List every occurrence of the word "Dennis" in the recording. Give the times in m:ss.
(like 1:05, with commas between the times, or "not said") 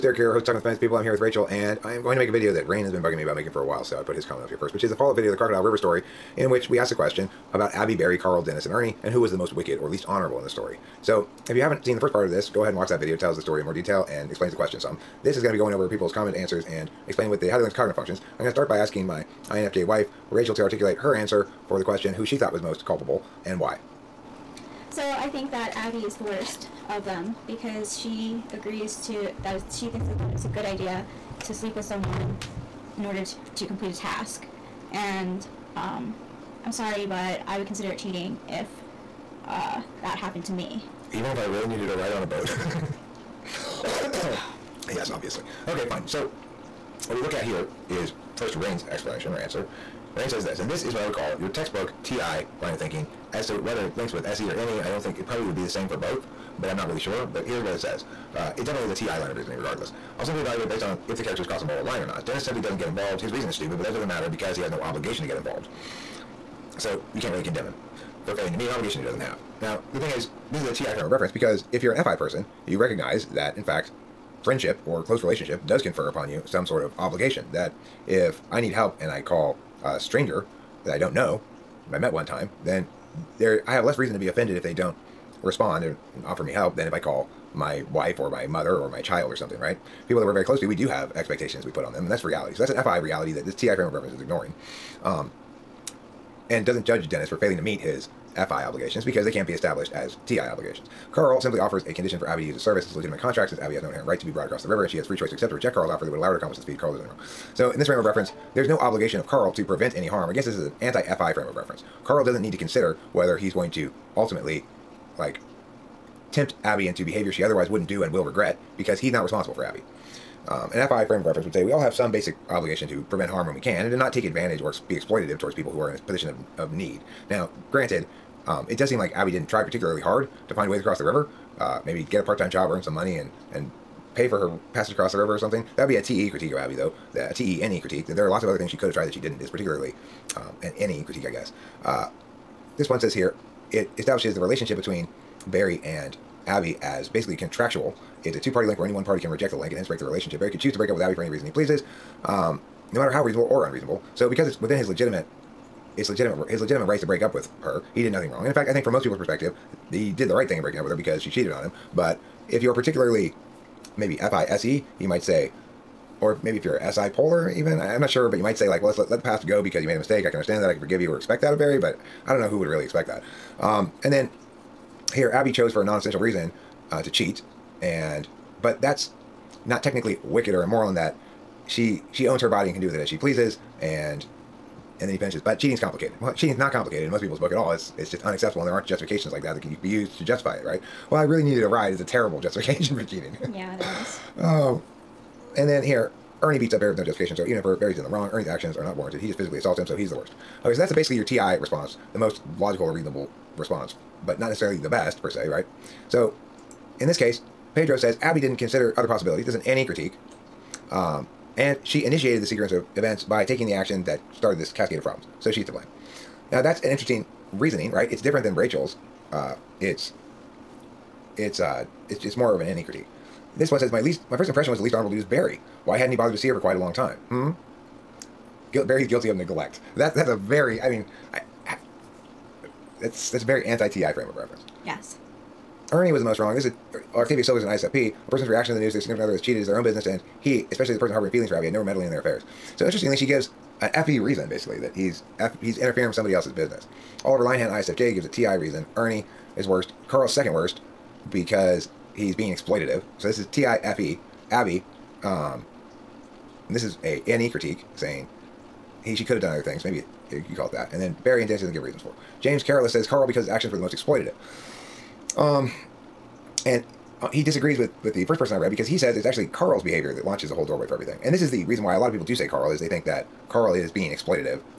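0:08, 1:02, 1:37, 4:21.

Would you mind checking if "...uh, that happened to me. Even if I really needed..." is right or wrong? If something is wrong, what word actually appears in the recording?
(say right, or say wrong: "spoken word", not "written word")
right.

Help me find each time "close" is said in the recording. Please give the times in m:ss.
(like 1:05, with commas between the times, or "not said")
1:15, 1:30.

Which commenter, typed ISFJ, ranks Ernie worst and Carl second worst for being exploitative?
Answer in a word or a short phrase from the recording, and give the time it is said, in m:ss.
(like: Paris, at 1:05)
Oliver Linehan, at 4:07.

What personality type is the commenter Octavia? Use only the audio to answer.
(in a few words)
ISFP.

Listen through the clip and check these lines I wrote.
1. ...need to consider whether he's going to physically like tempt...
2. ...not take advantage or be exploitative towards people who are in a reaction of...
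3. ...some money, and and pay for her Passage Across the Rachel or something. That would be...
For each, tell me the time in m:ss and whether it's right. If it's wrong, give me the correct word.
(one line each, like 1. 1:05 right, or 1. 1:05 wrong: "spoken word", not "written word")
1. 1:52 wrong: "ultimately", not "physically"
2. 2:03 wrong: "position", not "reaction"
3. 2:12 wrong: "River", not "Rachel".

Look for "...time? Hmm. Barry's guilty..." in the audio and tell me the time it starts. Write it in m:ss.
3:46.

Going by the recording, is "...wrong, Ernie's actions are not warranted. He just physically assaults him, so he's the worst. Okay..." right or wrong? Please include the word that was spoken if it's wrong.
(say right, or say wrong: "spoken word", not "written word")
right.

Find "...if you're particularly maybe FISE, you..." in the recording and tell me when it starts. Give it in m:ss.
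2:42.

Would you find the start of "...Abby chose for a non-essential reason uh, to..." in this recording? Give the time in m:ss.
2:55.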